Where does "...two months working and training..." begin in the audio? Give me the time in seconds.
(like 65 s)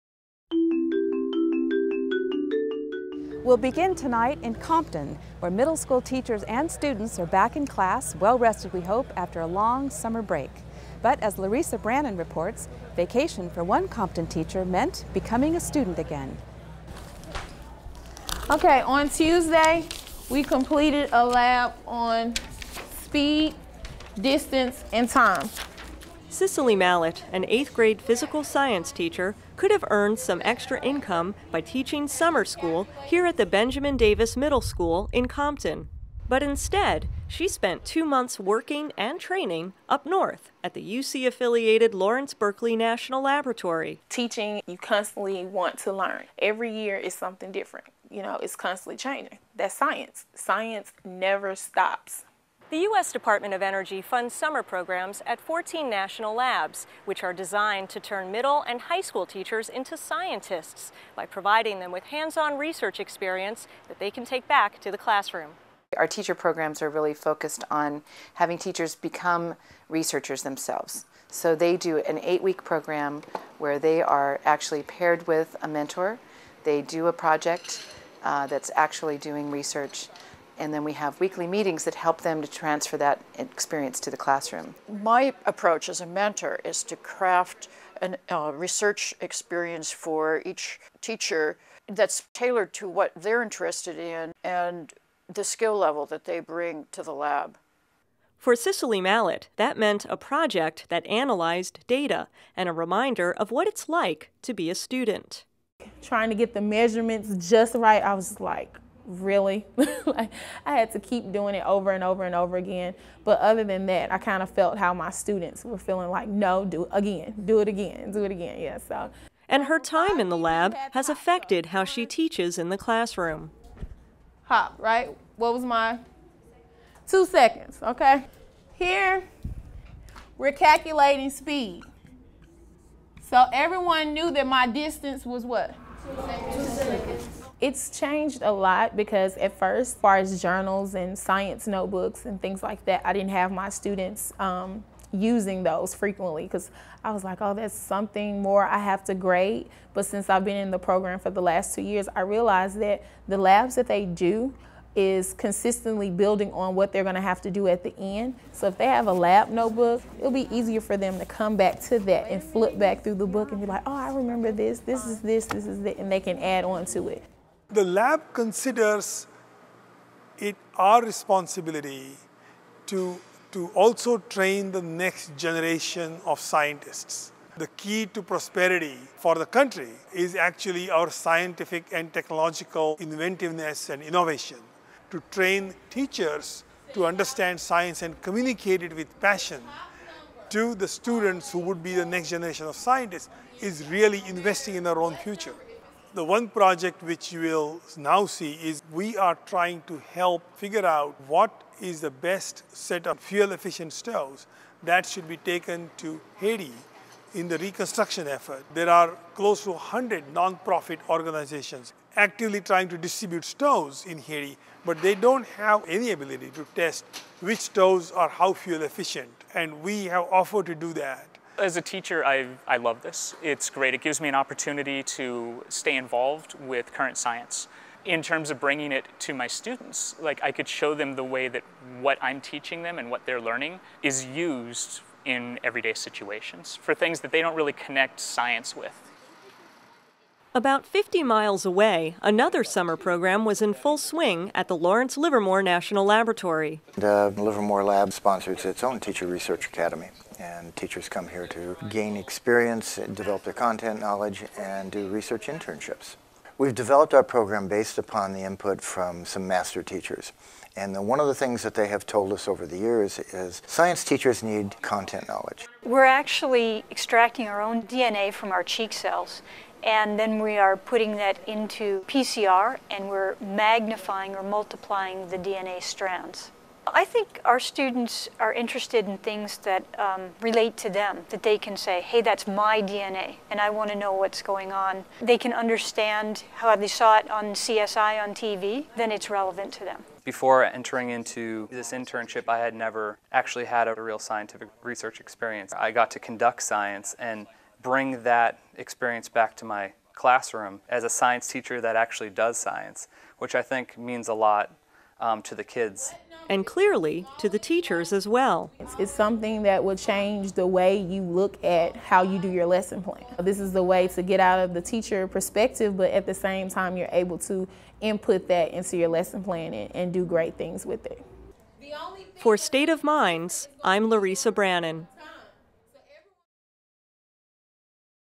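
37 s.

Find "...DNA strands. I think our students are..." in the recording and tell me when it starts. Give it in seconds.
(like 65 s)
275 s.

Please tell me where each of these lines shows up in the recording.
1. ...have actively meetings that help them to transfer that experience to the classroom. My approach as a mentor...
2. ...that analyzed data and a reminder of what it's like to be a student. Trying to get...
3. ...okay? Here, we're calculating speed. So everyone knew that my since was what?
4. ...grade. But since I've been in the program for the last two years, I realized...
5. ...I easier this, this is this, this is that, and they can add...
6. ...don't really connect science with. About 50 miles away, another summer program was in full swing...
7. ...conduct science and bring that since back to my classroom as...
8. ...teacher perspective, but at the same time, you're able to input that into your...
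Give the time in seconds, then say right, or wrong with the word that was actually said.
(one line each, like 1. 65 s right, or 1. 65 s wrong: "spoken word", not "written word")
1. 80 s wrong: "weekly", not "actively"
2. 100 s right
3. 127 s wrong: "distance", not "since"
4. 149 s right
5. 163 s wrong: "remember", not "easier"
6. 237 s right
7. 296 s wrong: "experience", not "since"
8. 314 s right.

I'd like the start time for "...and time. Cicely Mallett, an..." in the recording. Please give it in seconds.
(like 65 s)
24 s.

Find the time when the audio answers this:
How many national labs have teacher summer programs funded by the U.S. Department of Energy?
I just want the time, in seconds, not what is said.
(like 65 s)
55 s.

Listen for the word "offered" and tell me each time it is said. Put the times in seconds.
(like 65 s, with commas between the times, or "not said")
220 s.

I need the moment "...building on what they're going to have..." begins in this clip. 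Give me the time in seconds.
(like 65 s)
156 s.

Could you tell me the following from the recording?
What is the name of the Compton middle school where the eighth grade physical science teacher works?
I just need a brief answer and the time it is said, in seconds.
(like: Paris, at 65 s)
Benjamin Davis Middle School, at 33 s.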